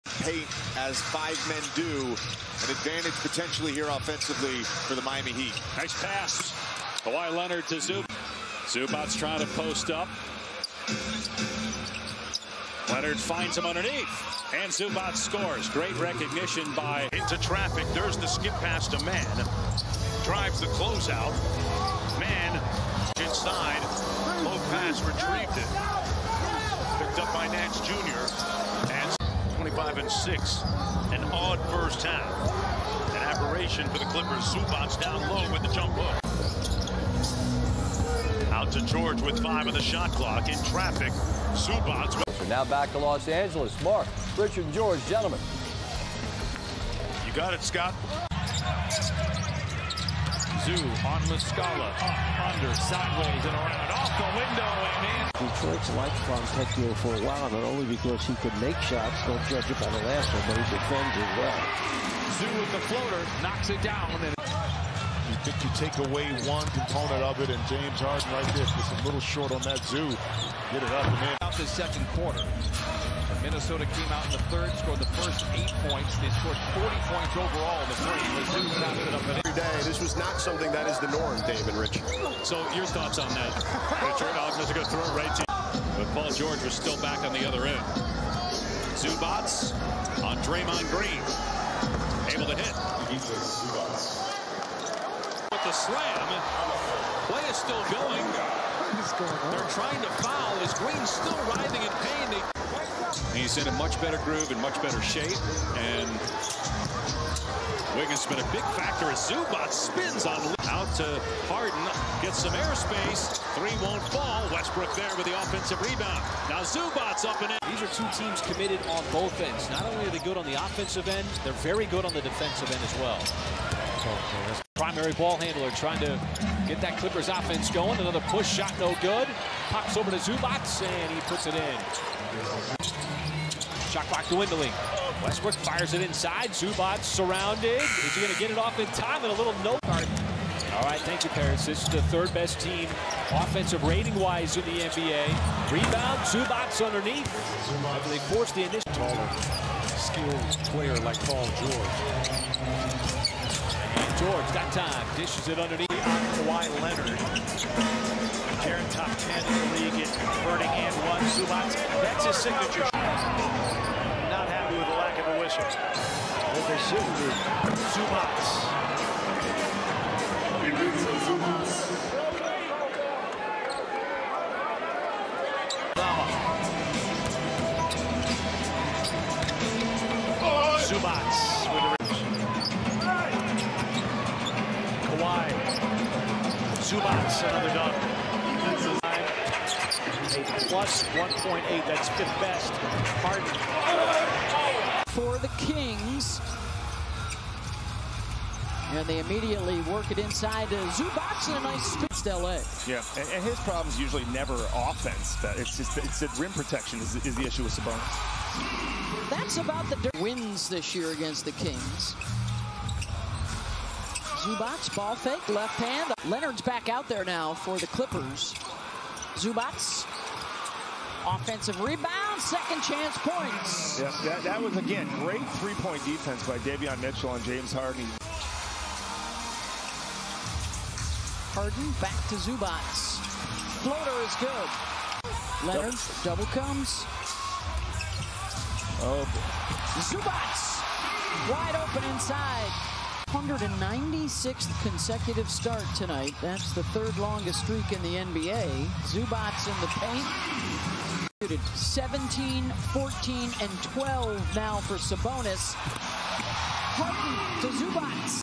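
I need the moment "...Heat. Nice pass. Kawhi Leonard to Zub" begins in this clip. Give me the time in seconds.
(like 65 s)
5 s.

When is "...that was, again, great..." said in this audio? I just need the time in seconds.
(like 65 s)
224 s.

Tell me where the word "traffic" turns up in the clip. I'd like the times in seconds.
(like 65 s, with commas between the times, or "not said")
17 s, 40 s.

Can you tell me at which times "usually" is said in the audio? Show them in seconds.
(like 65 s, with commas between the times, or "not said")
203 s.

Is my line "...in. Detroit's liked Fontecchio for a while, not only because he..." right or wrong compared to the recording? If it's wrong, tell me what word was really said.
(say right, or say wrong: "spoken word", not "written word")
right.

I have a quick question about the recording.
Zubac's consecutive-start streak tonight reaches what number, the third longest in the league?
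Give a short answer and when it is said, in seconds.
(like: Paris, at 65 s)
196, at 243 s.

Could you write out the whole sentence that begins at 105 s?
And Wiggins has been a big factor as Zubac spins on out to Harden, gets some airspace.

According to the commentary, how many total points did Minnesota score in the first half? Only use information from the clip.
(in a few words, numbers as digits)
40.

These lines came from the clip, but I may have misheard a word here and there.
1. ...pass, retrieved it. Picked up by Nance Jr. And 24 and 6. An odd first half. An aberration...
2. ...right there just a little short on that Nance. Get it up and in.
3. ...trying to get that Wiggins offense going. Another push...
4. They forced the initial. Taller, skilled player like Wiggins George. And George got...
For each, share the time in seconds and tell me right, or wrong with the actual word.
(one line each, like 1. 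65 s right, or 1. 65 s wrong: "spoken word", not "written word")
1. 24 s wrong: "25", not "24"
2. 68 s wrong: "Zoo", not "Nance"
3. 125 s wrong: "Clippers", not "Wiggins"
4. 148 s wrong: "Paul", not "Wiggins".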